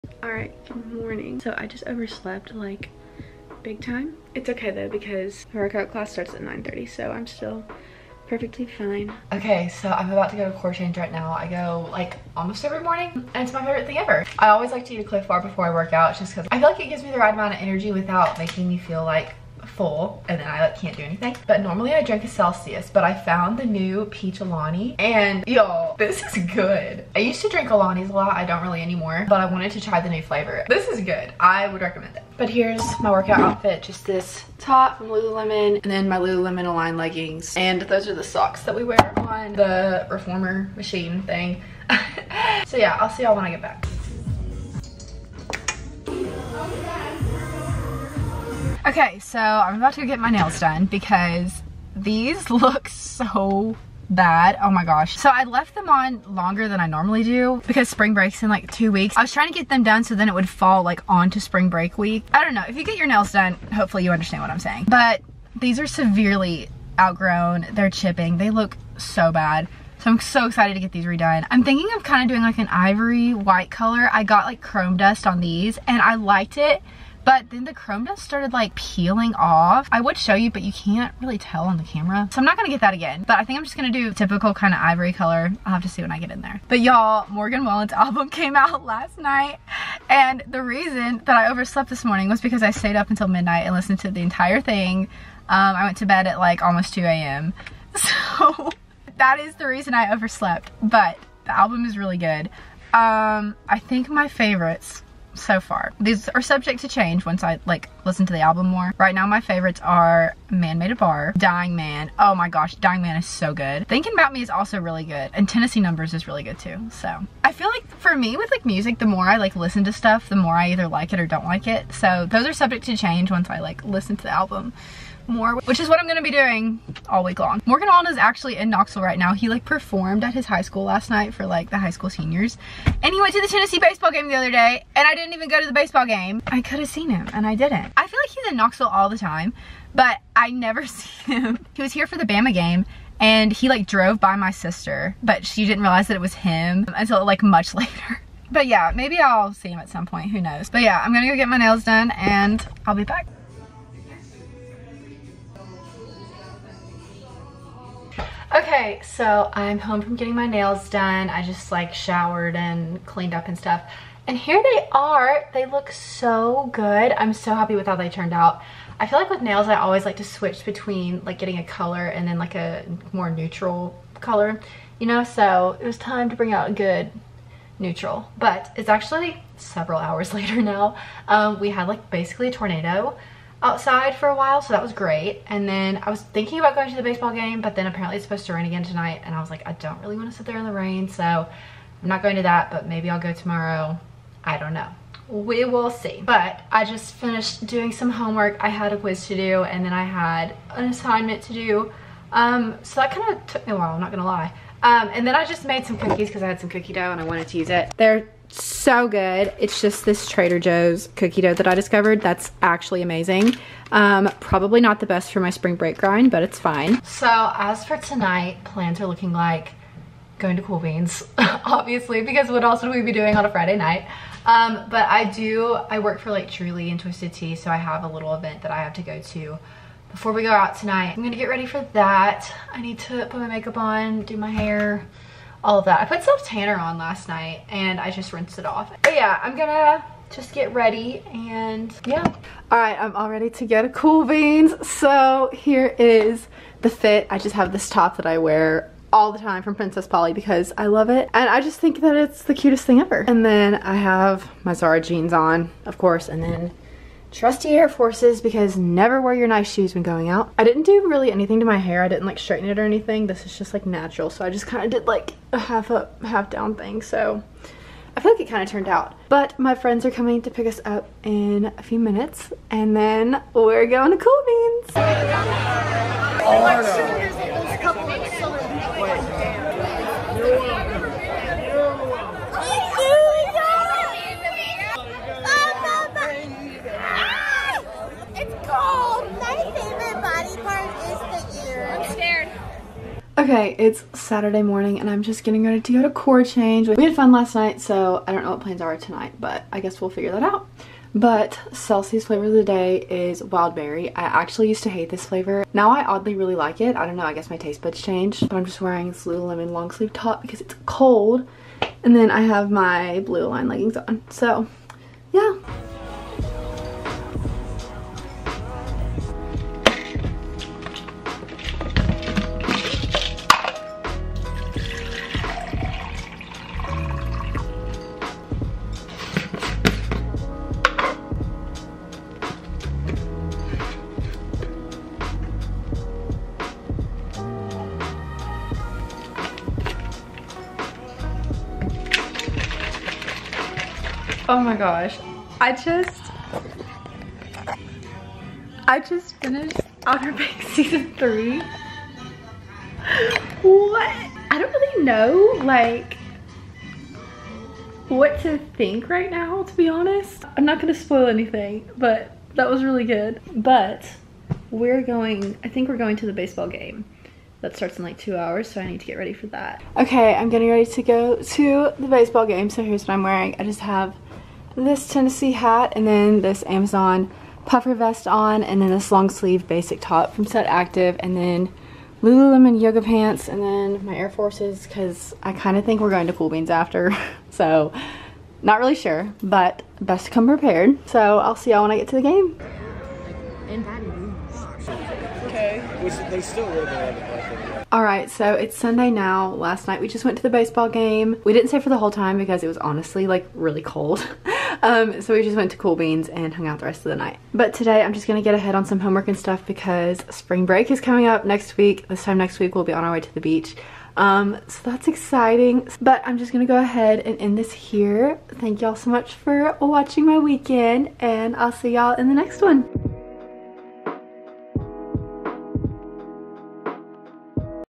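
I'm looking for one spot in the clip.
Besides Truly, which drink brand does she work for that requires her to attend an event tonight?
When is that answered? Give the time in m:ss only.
3:46.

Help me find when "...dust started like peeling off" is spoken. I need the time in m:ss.
1:18.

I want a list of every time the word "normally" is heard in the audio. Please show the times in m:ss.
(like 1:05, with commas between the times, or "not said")
0:21, 0:56.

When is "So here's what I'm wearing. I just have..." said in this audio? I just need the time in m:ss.
6:12.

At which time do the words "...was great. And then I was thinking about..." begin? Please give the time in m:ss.
3:04.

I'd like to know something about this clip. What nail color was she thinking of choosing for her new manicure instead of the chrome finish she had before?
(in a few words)
ivory white.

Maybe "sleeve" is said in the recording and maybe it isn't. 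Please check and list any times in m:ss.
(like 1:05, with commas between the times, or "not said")
5:09, 6:19.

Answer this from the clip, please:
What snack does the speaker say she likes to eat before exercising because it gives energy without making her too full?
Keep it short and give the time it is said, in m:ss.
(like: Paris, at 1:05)
Clif bar, at 0:15.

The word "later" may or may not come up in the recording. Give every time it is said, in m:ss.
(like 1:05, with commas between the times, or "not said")
2:27, 3:00.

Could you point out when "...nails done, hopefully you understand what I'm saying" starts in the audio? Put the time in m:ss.
1:03.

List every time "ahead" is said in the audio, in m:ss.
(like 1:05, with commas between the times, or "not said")
6:48, 6:56.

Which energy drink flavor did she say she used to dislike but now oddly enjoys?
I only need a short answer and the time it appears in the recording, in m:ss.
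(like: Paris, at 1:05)
wild berry, at 5:03.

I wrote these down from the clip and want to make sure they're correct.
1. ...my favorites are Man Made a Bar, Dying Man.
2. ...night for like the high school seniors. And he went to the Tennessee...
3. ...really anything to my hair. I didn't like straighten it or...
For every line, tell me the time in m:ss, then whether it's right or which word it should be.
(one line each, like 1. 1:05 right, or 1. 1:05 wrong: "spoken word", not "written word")
1. 1:49 right
2. 2:11 right
3. 4:21 right.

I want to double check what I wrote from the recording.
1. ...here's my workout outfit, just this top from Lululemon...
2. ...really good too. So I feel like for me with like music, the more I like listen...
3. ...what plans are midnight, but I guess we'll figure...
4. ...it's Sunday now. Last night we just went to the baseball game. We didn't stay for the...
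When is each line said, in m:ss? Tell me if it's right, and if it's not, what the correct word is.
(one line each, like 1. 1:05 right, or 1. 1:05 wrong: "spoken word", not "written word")
1. 0:32 right
2. 1:56 right
3. 4:58 wrong: "tonight", not "midnight"
4. 6:38 right.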